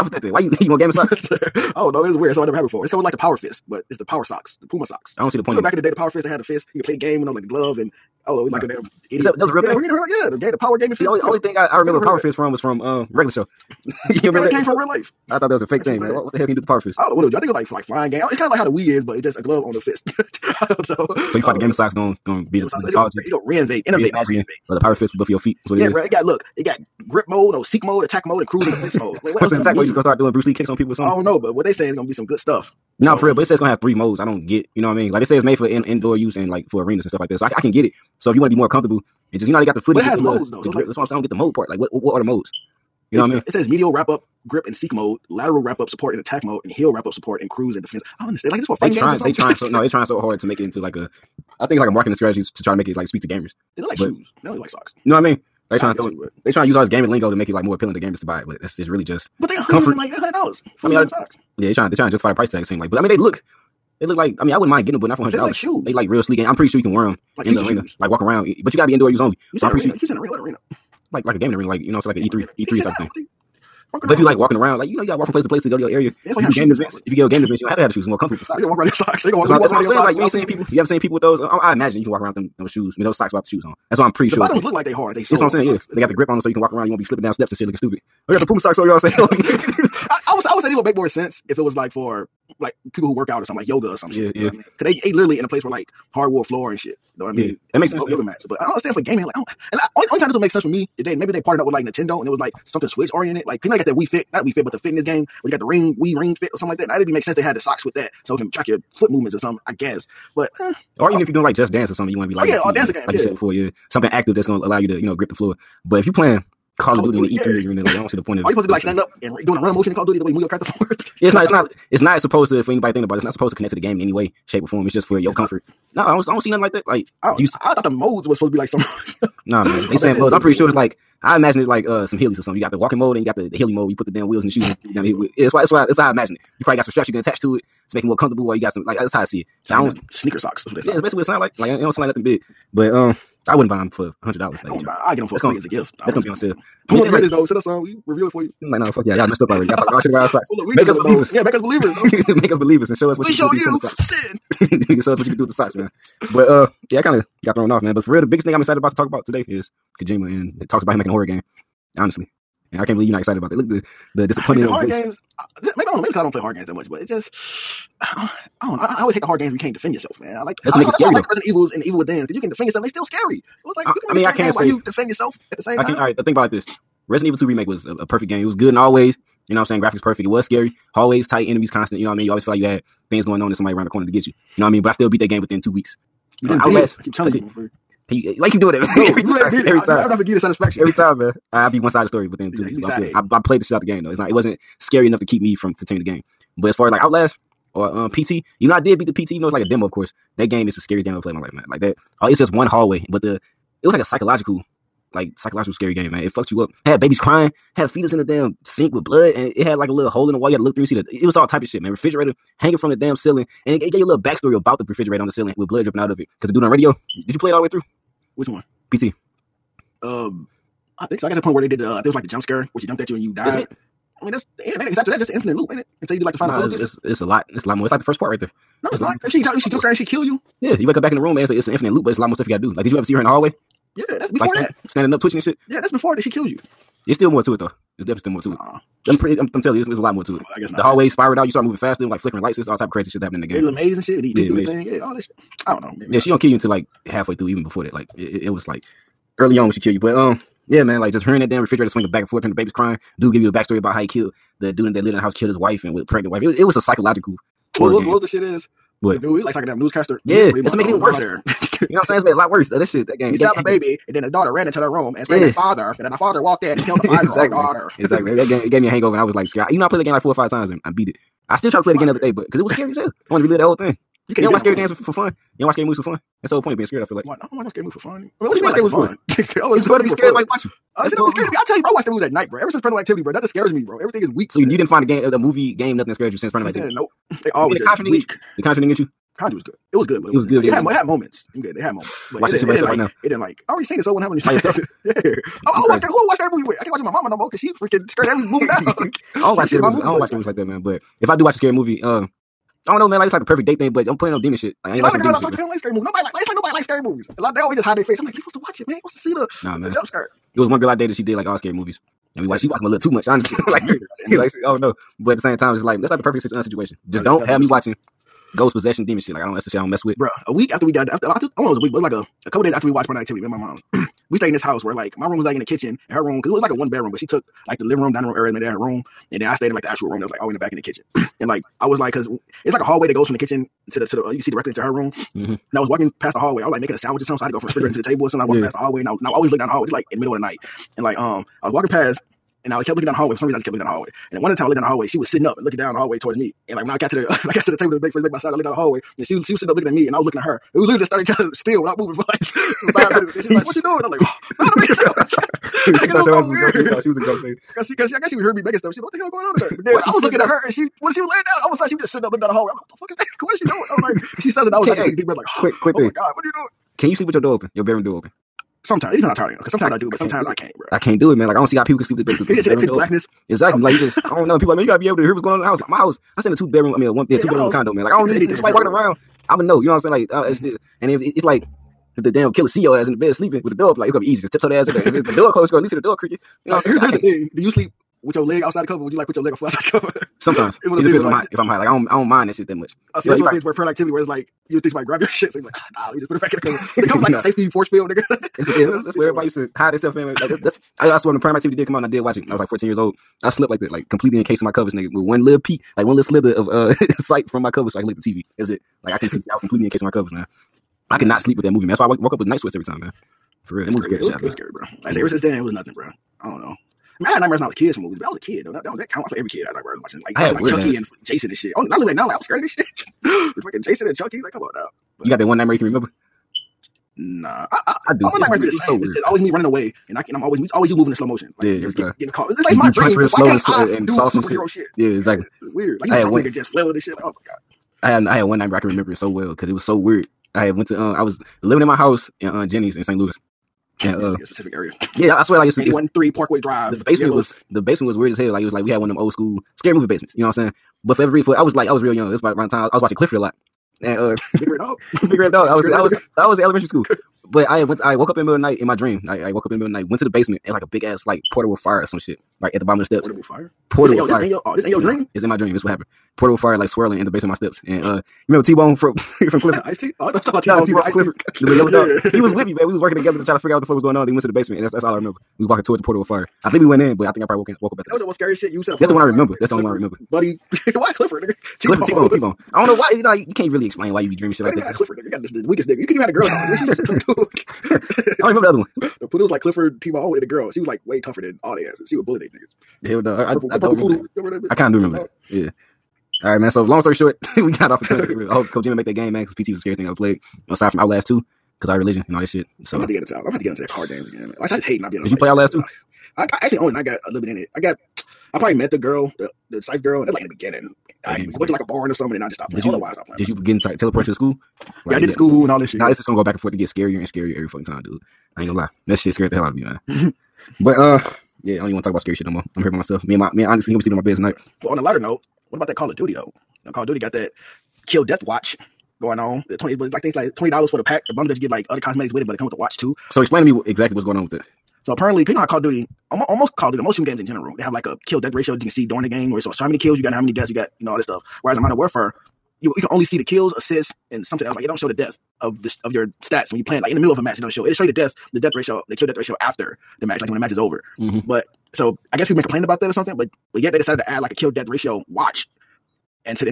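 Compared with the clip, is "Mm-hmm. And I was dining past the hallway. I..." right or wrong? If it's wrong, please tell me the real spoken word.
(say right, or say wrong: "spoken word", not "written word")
wrong: "walking", not "dining".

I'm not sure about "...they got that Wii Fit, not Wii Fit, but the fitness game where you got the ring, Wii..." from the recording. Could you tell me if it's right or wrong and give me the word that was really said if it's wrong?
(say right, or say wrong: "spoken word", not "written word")
right.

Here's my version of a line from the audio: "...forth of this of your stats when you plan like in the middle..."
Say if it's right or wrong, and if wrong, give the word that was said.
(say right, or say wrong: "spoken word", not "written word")
wrong: "death", not "forth".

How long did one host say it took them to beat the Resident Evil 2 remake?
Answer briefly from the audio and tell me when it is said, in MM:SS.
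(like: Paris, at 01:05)
two weeks, at 03:05.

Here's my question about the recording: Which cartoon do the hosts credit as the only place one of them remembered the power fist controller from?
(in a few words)
Regular Show.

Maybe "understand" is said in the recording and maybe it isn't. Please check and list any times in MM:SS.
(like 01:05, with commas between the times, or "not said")
00:48, 01:38.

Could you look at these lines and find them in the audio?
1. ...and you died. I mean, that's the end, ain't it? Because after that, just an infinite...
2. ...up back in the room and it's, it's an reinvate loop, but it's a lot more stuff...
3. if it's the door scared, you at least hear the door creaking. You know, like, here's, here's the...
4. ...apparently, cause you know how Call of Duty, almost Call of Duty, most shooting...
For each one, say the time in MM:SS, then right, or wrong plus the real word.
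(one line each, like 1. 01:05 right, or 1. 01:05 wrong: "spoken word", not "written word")
1. 03:43 right
2. 03:50 wrong: "infinite", not "reinvate"
3. 06:25 wrong: "closed", not "scared"
4. 08:55 right.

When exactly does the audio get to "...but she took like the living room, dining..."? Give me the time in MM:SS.
05:27.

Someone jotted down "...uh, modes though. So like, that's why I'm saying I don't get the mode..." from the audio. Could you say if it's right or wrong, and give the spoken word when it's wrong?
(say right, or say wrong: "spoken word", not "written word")
right.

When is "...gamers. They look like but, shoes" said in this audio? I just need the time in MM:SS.
00:53.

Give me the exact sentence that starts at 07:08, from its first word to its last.
All my it's nightmares be the same.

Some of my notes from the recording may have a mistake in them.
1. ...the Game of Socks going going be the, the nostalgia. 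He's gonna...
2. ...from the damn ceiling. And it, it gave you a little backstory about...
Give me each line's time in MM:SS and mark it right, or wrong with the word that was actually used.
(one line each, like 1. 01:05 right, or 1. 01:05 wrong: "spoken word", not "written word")
1. 00:21 right
2. 03:32 right.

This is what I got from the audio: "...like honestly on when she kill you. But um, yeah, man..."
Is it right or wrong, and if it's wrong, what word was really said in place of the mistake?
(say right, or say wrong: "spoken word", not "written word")
wrong: "early", not "honestly".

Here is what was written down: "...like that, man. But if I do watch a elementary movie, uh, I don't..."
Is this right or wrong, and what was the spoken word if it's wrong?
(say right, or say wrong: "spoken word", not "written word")
wrong: "scary", not "elementary".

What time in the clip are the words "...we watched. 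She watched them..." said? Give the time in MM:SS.
05:12.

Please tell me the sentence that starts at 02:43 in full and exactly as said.
Look the the disappointment horror voice.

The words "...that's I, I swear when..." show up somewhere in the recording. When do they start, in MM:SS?
06:40.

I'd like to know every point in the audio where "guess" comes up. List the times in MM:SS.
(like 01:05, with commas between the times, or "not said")
01:49, 04:00, 05:58, 09:12.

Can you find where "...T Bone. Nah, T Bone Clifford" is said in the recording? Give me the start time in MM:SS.
07:50.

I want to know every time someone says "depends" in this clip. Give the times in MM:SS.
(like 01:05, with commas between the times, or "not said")
06:09, 06:30.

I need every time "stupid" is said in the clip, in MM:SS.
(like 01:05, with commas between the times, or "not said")
01:27.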